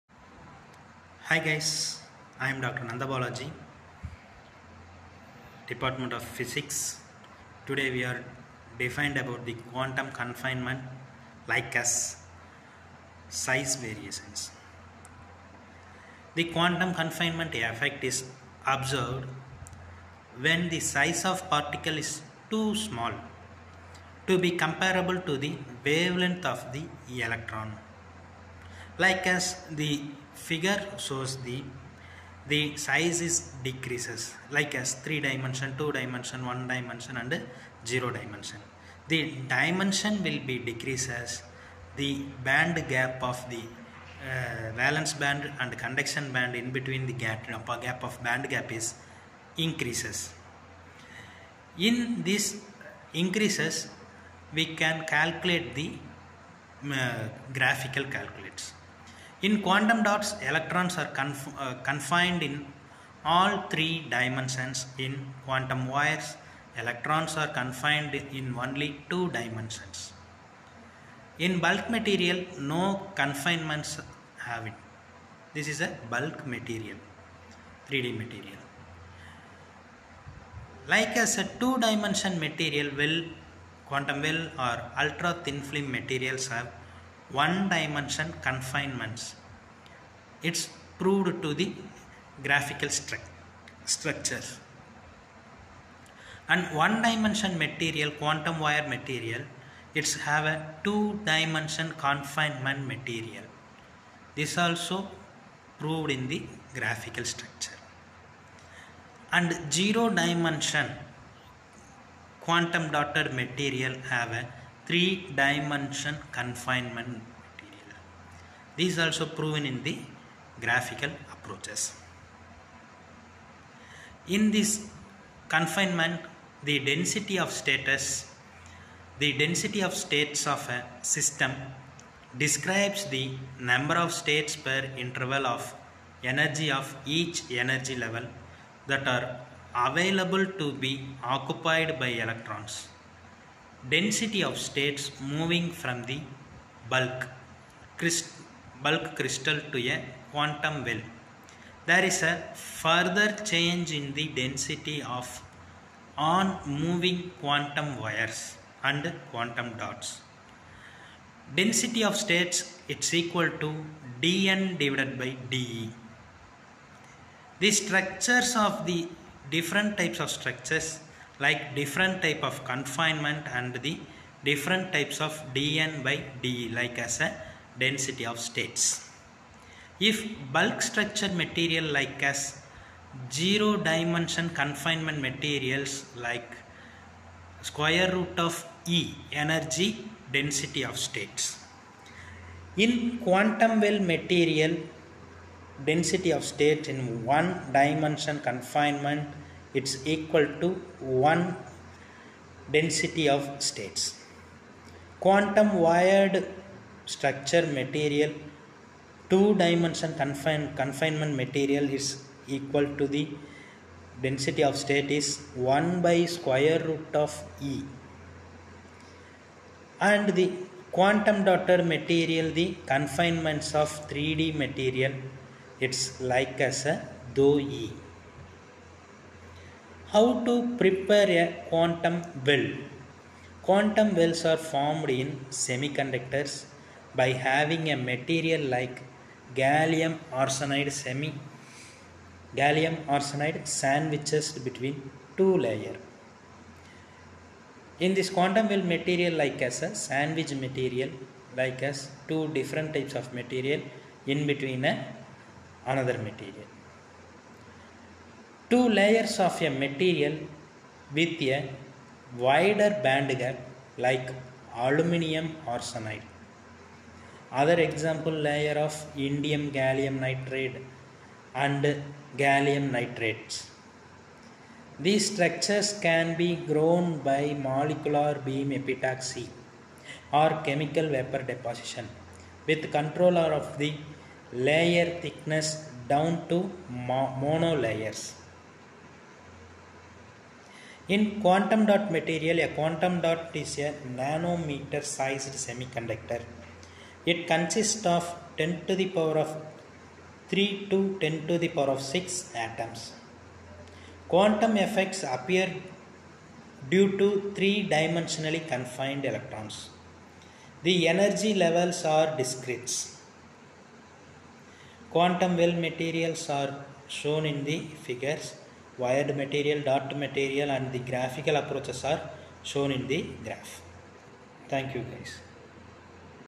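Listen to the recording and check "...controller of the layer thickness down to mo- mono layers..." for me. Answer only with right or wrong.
right.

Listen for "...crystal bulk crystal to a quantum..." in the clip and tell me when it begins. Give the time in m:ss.
2:27.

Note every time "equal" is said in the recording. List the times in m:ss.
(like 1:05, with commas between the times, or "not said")
2:43, 3:20, 3:32.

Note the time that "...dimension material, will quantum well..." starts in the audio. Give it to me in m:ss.
1:21.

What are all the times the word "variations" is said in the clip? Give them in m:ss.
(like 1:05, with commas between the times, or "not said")
0:13.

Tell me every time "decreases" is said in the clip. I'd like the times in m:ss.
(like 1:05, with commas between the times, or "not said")
0:33, 0:40.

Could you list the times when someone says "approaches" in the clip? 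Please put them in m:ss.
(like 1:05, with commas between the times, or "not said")
2:01, 5:21.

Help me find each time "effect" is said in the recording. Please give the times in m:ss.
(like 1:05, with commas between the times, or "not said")
0:17, 5:04.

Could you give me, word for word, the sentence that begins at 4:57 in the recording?
It consists of 10 to the power of 3 to 10 to the power of 6 atoms.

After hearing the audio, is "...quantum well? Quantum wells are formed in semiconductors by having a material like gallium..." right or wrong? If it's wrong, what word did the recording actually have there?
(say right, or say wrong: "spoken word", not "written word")
right.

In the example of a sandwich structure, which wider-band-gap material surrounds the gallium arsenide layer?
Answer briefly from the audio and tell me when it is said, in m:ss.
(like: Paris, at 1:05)
Aluminium arsenide, at 4:24.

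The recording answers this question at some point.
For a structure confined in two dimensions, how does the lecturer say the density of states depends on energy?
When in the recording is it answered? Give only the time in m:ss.
3:35.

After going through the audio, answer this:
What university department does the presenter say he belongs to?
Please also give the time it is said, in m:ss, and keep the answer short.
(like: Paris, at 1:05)
Physics, at 0:05.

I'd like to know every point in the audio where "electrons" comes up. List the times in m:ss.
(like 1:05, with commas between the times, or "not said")
0:27, 1:00, 1:06, 2:22, 5:09.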